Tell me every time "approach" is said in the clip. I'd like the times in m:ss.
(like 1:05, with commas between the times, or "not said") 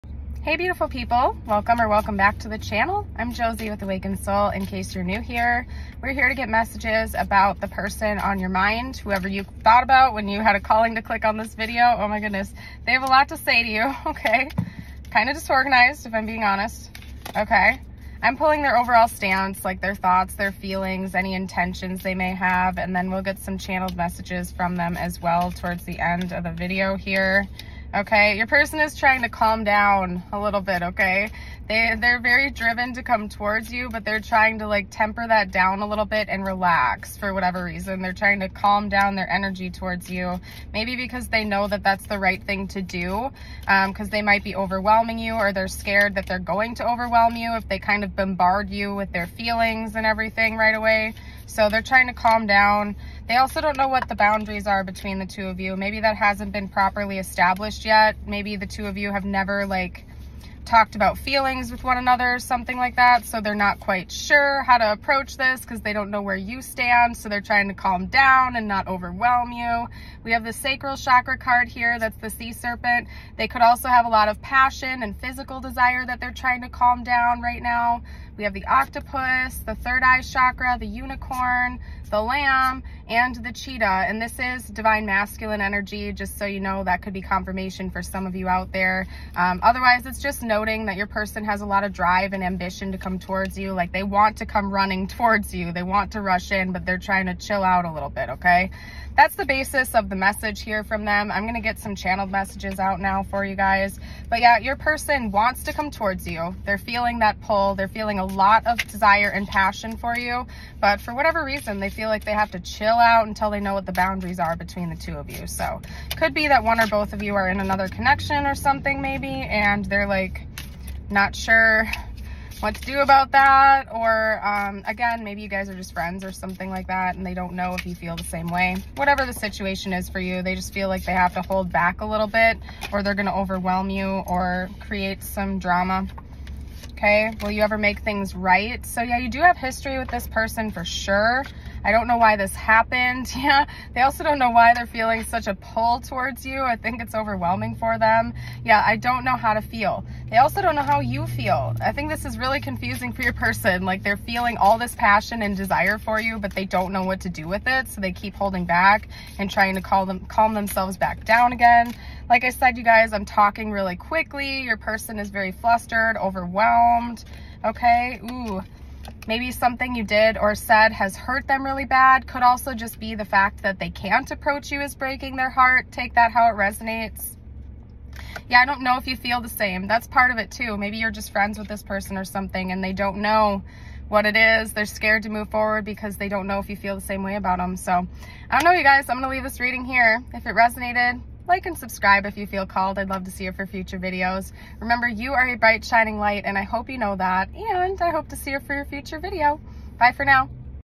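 1:04, 2:54.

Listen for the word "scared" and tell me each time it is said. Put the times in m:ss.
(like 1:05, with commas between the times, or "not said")
0:45, 3:04.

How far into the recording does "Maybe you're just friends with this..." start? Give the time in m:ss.
3:00.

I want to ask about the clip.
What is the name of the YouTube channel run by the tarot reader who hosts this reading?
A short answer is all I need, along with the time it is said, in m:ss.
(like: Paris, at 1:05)
Awakened Soul, at 0:03.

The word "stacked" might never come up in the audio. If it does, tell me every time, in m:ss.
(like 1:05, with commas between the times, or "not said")
not said.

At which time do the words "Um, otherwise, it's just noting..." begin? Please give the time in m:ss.
1:29.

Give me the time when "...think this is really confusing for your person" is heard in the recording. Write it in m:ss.
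2:31.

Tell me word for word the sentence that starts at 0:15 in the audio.
Kind of disorganized if I'm being honest, okay?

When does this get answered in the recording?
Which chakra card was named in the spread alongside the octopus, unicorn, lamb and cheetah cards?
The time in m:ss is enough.
1:19.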